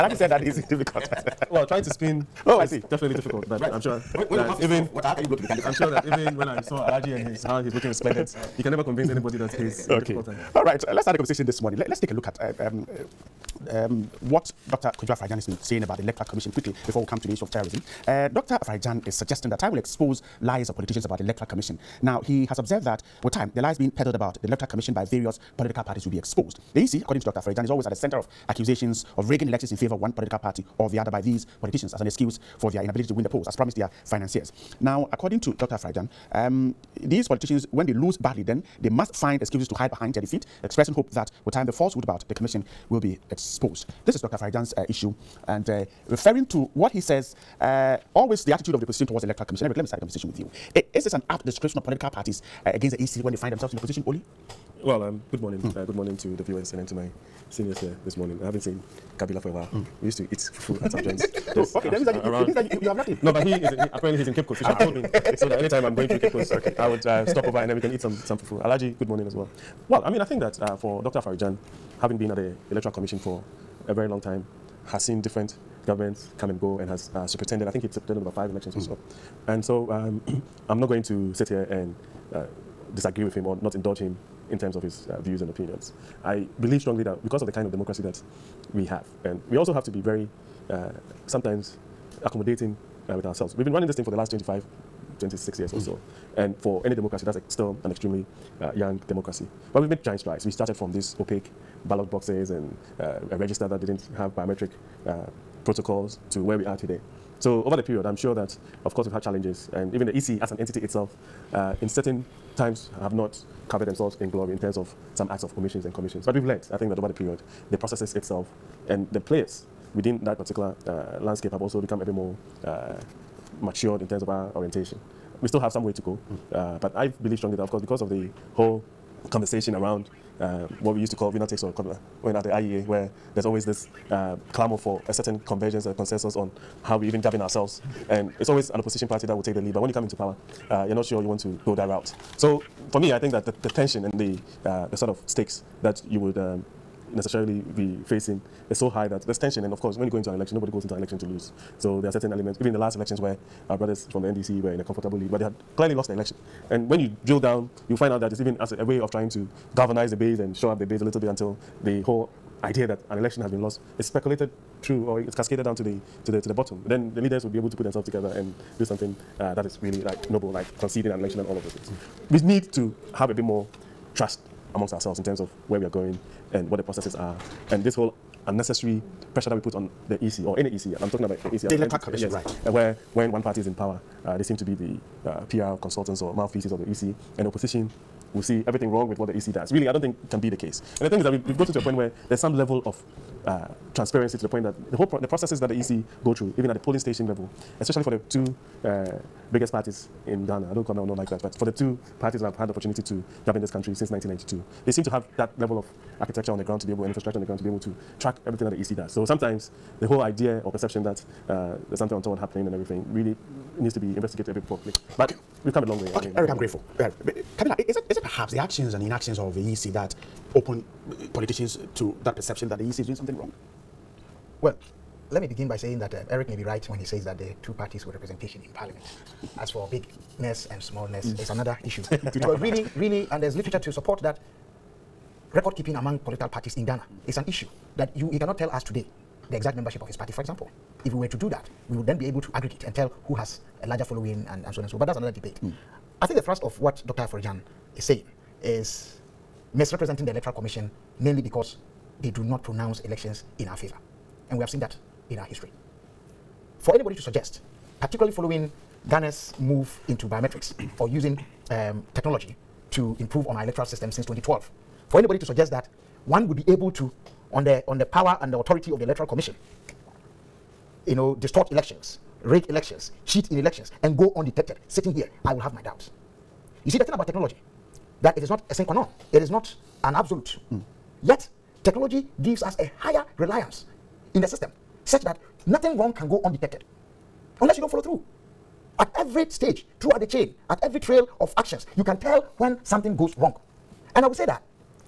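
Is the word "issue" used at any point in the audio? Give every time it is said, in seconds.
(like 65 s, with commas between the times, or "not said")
17 s, 44 s, 231 s, 237 s.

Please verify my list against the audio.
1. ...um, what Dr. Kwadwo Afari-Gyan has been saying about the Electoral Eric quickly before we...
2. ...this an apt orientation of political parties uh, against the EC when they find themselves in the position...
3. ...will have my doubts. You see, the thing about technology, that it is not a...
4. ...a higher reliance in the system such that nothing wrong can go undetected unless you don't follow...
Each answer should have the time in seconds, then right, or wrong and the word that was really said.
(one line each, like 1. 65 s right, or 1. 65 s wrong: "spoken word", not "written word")
1. 13 s wrong: "Commission", not "Eric"
2. 51 s wrong: "description", not "orientation"
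3. 275 s right
4. 282 s right.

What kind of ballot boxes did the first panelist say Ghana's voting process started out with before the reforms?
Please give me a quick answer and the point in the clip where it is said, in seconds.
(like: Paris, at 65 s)
Opaque ballot boxes, at 101 s.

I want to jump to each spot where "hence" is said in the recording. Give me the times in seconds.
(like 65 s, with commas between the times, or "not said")
not said.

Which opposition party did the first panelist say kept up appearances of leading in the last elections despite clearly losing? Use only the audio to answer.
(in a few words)
NDC.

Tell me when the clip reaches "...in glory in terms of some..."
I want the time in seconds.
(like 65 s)
114 s.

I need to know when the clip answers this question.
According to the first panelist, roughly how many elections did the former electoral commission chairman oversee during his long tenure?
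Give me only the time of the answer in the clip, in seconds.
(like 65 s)
78 s.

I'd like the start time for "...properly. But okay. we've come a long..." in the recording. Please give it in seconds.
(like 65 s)
214 s.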